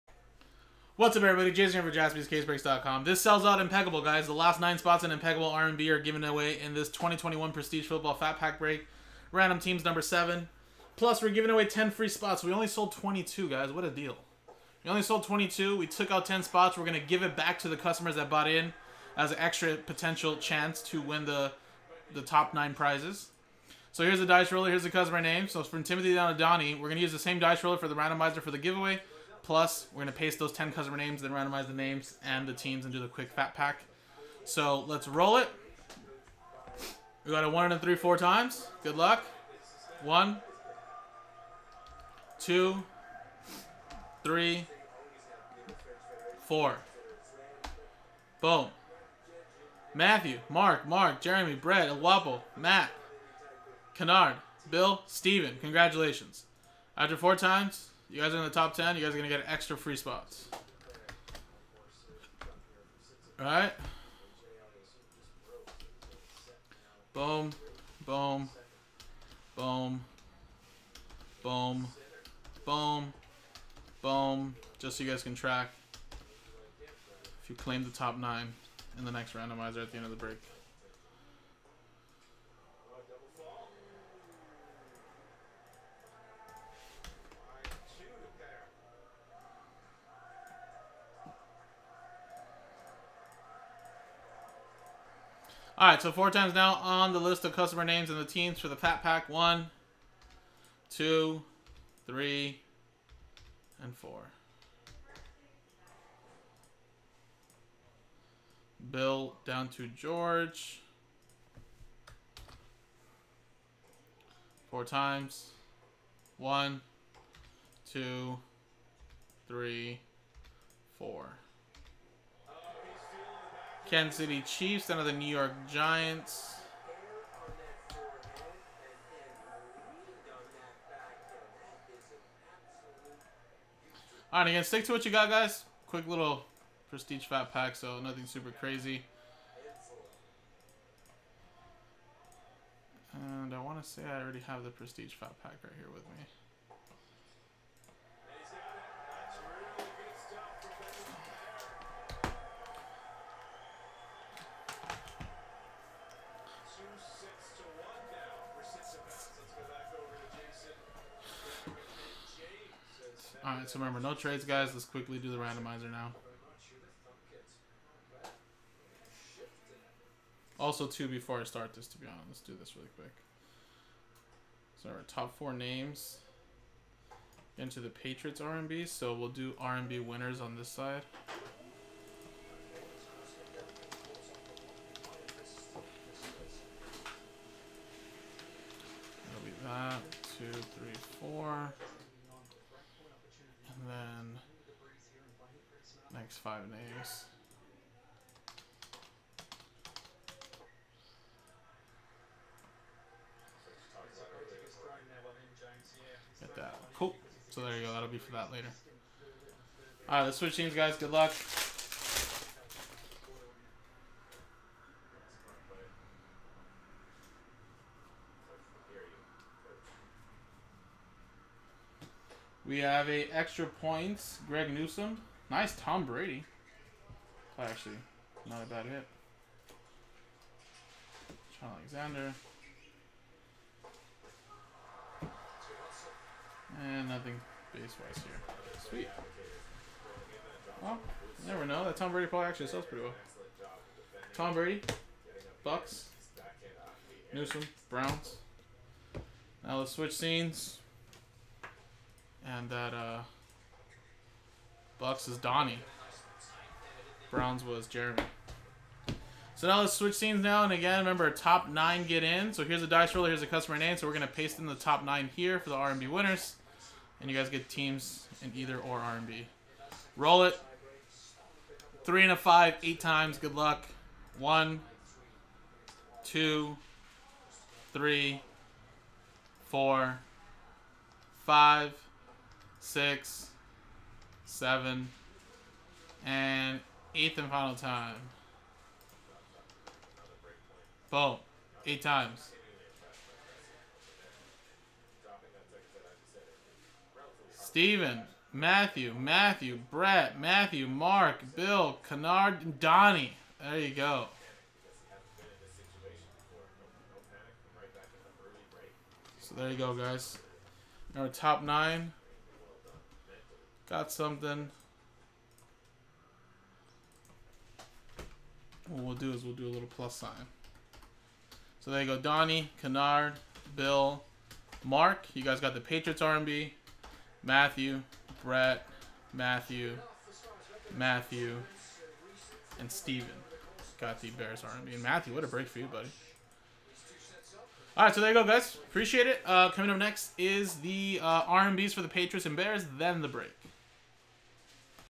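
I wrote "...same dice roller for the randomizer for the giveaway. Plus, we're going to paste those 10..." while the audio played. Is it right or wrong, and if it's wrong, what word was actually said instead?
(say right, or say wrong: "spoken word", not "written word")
right.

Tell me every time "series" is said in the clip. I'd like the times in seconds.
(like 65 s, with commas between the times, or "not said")
not said.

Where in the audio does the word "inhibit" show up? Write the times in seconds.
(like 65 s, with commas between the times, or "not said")
not said.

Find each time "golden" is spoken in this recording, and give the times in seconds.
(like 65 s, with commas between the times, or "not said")
not said.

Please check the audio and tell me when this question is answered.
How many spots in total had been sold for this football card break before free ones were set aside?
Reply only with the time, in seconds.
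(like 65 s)
12 s.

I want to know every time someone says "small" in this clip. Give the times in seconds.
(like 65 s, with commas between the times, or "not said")
not said.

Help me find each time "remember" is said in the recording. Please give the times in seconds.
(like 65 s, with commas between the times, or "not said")
163 s, 260 s.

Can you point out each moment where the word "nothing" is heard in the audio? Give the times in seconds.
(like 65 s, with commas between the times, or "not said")
137 s, 237 s.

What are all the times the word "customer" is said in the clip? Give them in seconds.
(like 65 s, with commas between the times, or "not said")
17 s, 24 s, 30 s, 97 s, 263 s.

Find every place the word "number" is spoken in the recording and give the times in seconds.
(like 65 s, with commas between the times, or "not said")
9 s.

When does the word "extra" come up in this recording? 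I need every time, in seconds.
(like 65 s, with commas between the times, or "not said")
19 s, 59 s, 223 s.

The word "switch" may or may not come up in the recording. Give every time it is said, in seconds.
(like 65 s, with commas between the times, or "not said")
210 s, 249 s, 259 s.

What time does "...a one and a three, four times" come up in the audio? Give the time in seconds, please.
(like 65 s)
37 s.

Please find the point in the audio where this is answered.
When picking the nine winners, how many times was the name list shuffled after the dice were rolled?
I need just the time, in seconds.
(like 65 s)
272 s.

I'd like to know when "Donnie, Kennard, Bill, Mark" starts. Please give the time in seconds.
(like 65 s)
322 s.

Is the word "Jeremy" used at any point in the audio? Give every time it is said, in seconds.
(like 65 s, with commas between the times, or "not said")
51 s, 257 s.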